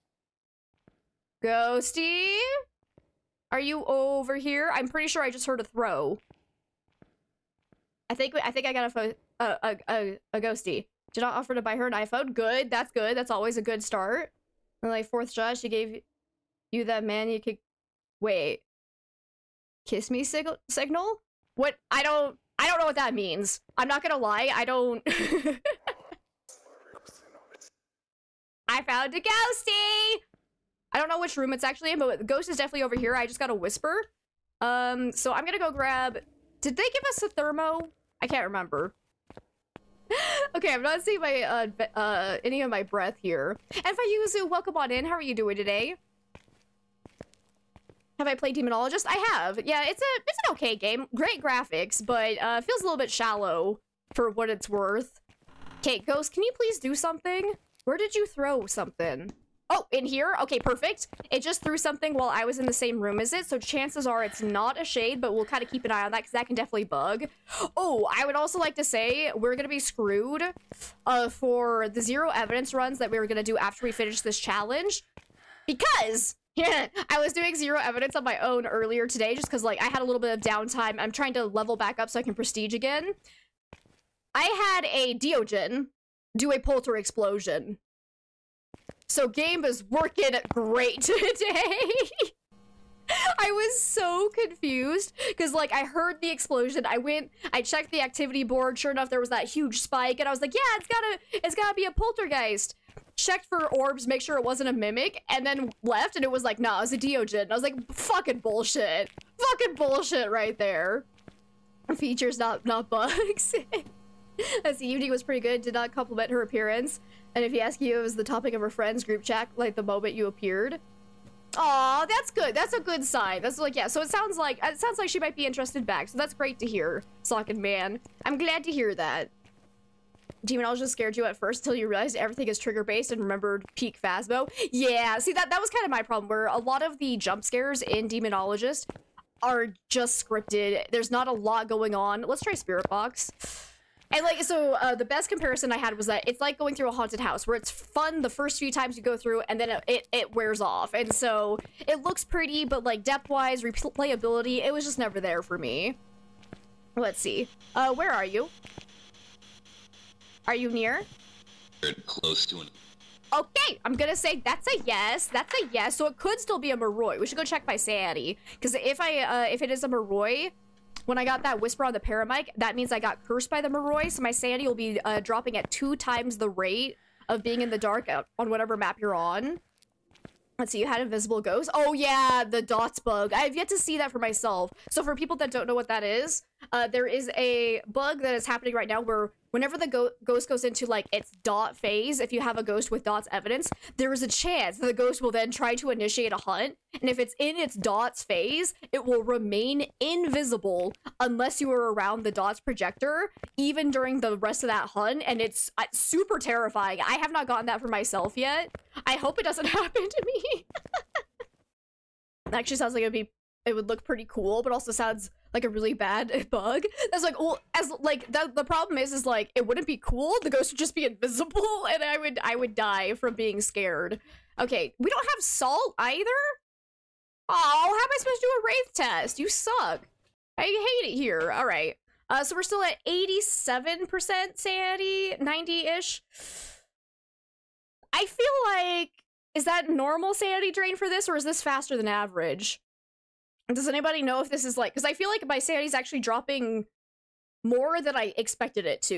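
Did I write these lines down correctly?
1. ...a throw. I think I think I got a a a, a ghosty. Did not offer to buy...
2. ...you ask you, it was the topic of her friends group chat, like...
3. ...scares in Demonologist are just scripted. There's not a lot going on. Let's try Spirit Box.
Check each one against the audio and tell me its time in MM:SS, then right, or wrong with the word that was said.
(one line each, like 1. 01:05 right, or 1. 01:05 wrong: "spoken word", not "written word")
1. 00:05 right
2. 01:57 right
3. 02:17 right.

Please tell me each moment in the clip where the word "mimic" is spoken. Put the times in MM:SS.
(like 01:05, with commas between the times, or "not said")
01:44.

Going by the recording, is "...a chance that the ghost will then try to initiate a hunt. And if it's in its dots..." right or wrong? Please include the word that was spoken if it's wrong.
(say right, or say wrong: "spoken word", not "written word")
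right.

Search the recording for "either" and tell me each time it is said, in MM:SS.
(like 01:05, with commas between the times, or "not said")
03:45.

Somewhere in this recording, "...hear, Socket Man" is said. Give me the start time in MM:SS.
02:06.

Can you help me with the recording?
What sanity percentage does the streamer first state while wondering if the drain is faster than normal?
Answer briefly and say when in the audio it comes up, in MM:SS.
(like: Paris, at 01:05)
87%, at 03:53.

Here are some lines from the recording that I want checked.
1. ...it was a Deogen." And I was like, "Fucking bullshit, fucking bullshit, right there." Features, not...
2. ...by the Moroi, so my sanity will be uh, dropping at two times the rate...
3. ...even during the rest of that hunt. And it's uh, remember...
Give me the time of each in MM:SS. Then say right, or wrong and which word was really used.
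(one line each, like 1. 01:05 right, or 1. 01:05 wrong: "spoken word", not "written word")
1. 01:46 right
2. 02:53 right
3. 03:23 wrong: "super", not "remember".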